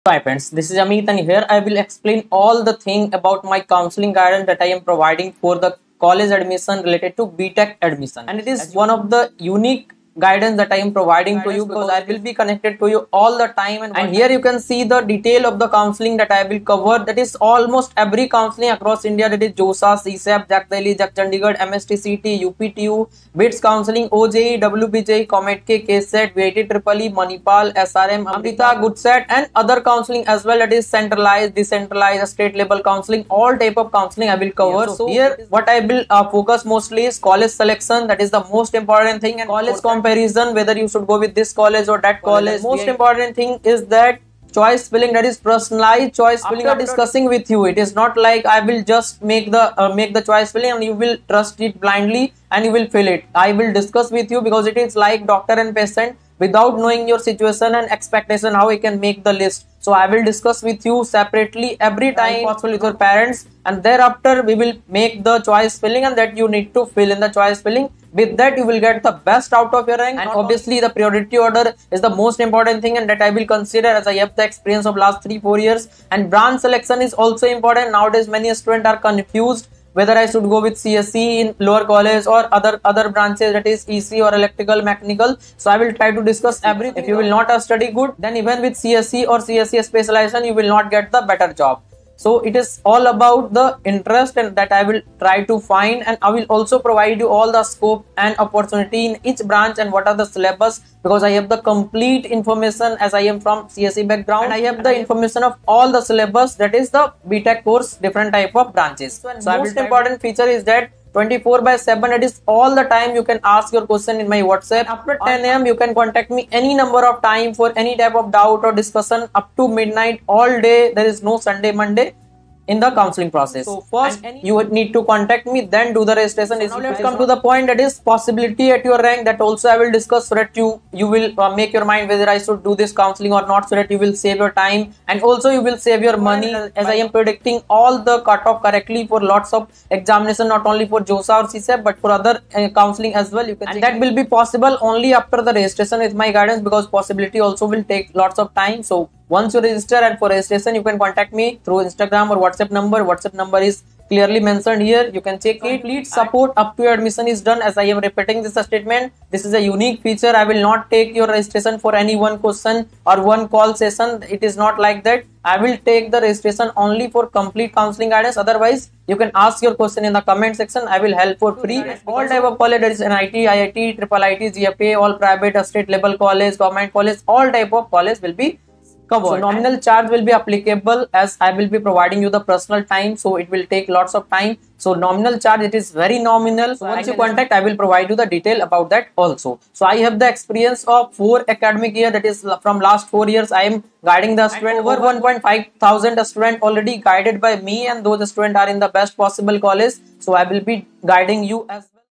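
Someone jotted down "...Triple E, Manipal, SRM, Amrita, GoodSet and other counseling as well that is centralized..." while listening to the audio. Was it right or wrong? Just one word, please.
right.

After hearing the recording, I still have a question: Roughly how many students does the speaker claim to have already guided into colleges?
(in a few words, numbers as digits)
1,500.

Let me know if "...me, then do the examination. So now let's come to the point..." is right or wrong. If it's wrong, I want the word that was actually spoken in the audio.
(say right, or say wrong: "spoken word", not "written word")
wrong: "registration", not "examination".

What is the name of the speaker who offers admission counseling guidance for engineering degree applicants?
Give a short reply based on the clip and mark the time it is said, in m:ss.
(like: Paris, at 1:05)
Amit, at 0:00.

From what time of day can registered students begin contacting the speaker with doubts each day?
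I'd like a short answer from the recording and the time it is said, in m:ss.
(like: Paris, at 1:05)
10 am, at 1:55.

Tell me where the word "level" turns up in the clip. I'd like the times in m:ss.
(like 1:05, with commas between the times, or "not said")
0:32, 2:55.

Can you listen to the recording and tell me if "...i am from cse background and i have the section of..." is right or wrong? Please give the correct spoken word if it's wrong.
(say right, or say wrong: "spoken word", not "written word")
wrong: "information", not "section".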